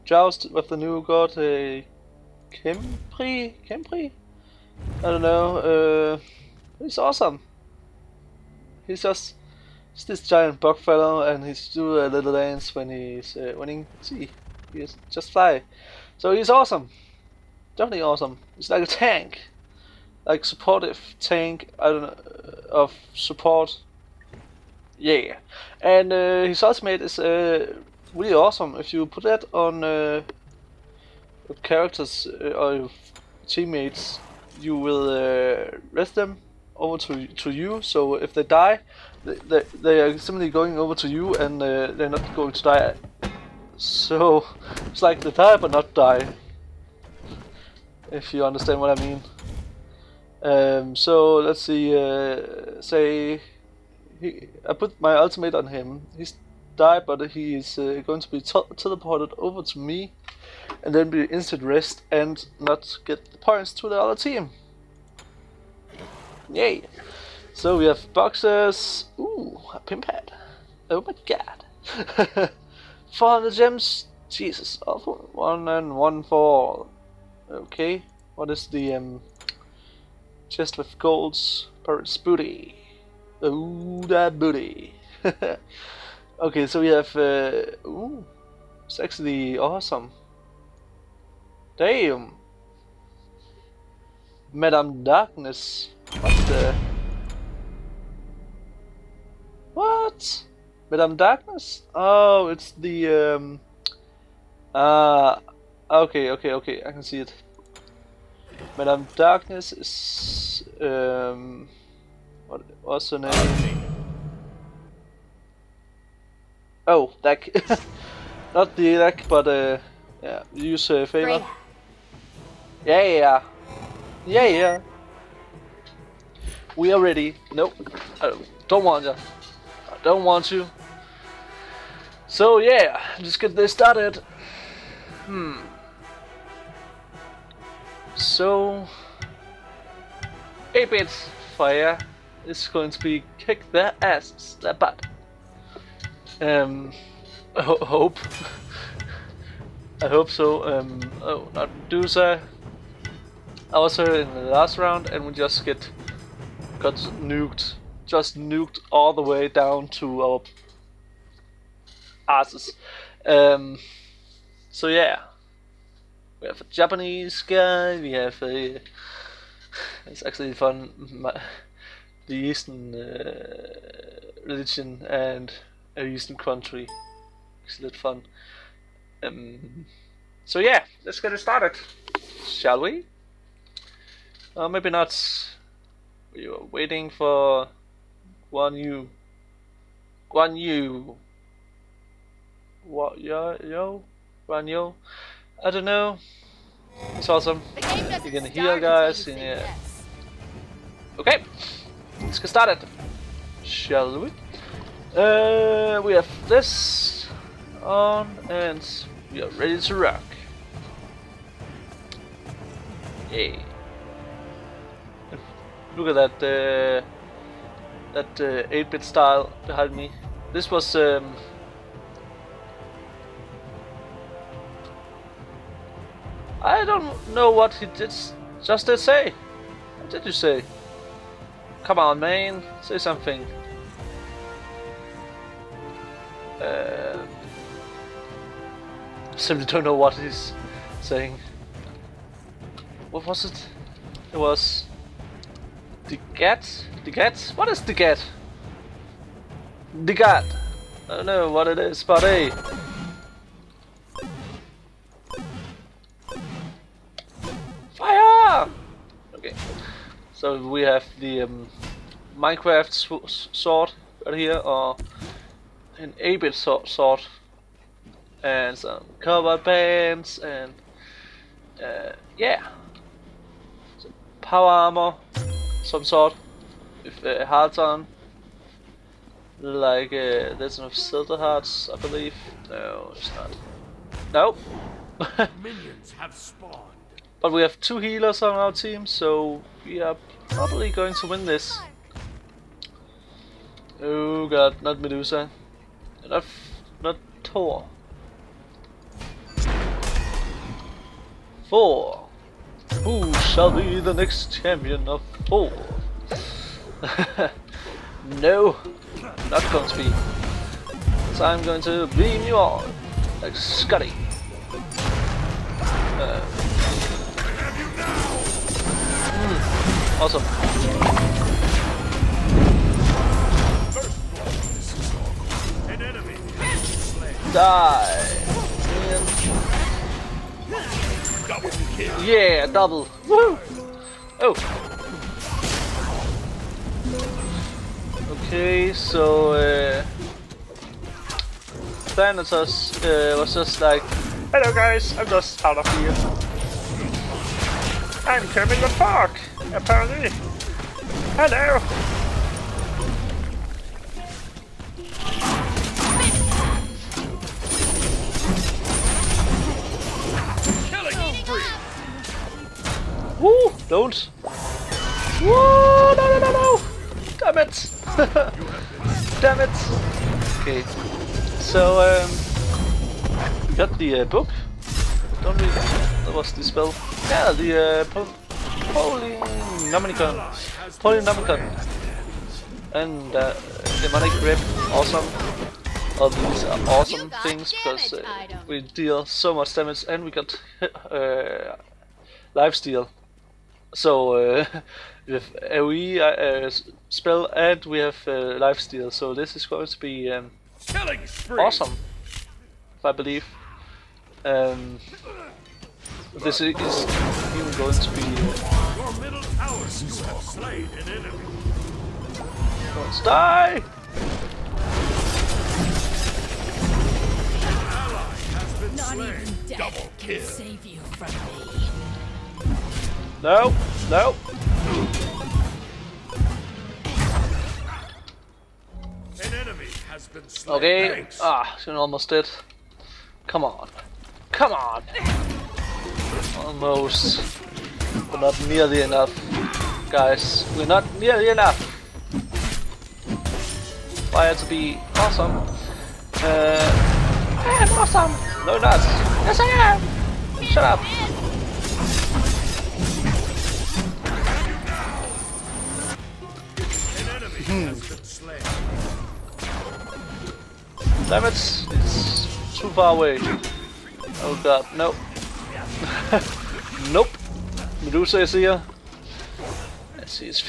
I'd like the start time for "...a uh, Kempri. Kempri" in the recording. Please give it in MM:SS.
00:01.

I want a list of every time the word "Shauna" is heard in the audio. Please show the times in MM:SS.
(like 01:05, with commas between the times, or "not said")
not said.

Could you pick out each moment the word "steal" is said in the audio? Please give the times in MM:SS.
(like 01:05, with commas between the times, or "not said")
06:32, 06:38.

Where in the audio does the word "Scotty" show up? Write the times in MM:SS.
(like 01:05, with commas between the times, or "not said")
05:13.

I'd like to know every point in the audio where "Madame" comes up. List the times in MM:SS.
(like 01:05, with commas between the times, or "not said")
01:34, 01:40, 01:48.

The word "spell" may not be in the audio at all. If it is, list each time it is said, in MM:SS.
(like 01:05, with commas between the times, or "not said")
06:16, 06:37.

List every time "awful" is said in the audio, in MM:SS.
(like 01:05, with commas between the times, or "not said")
01:14.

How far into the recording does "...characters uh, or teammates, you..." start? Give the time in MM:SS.
00:31.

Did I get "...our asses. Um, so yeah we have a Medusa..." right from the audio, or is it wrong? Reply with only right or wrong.
wrong.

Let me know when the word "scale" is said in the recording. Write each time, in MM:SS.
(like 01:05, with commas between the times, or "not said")
not said.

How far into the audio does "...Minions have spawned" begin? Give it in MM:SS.
04:45.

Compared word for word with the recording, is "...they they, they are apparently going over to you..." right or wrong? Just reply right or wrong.
wrong.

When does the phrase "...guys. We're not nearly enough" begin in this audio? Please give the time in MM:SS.
07:20.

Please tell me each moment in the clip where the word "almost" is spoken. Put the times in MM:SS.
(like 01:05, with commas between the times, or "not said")
07:11, 07:16.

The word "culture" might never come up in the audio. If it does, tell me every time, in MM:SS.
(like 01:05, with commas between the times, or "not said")
not said.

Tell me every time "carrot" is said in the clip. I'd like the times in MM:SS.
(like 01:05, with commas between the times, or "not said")
not said.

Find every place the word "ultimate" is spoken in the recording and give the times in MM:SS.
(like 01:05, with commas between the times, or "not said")
00:26, 00:55.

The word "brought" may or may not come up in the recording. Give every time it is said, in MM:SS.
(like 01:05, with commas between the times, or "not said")
not said.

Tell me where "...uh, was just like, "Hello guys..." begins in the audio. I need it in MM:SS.
05:43.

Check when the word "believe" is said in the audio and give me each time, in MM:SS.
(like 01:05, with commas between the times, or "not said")
04:41, 06:43.